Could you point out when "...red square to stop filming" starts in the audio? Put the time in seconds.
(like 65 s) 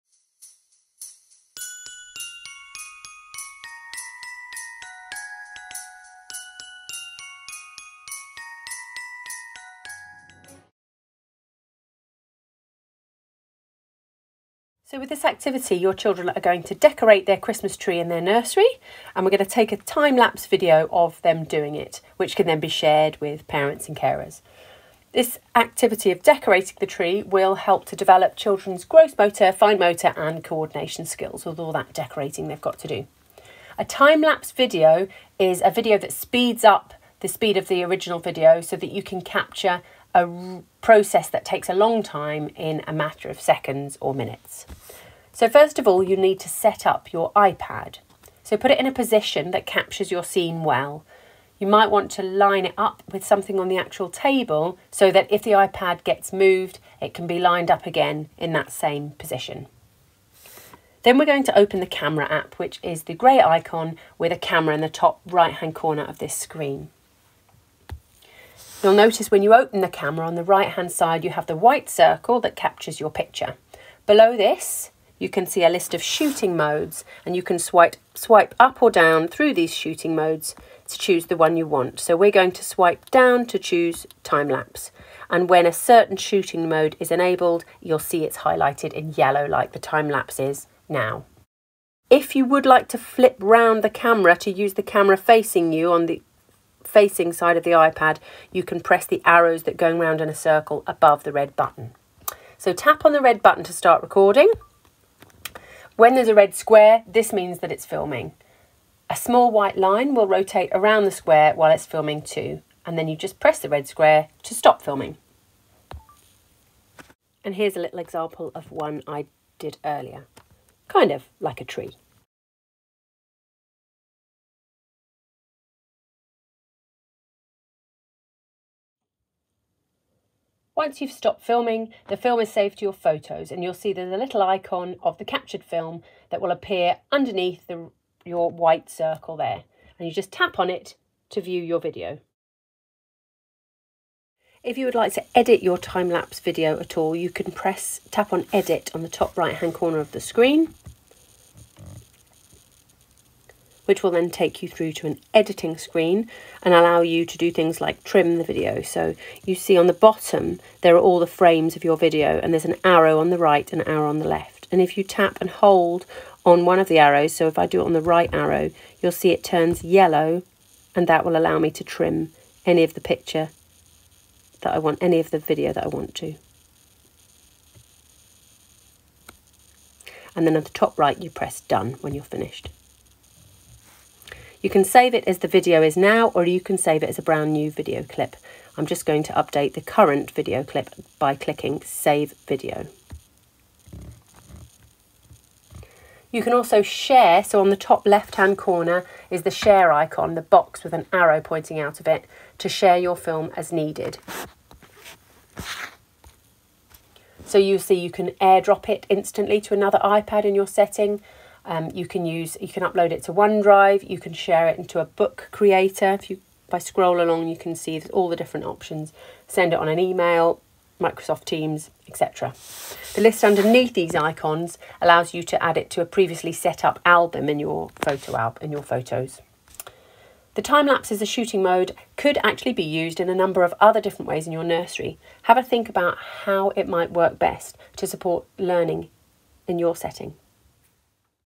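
113 s.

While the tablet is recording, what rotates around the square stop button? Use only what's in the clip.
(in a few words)
A small white line.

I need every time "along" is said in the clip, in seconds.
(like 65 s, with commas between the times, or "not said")
217 s.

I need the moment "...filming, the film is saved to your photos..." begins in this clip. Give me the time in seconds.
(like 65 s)
131 s.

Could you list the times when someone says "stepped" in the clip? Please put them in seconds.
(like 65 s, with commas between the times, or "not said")
not said.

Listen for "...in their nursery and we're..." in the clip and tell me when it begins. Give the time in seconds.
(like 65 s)
17 s.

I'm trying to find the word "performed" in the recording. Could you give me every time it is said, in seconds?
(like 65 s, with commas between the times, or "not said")
not said.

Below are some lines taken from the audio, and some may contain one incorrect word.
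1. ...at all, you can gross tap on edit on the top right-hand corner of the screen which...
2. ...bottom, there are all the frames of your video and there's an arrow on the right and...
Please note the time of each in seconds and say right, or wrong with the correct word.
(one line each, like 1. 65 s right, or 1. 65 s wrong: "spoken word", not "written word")
1. 146 s wrong: "press", not "gross"
2. 159 s right.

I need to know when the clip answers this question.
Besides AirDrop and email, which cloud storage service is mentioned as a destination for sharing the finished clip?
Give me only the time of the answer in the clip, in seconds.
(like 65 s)
213 s.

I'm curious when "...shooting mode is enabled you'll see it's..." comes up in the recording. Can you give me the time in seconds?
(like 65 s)
86 s.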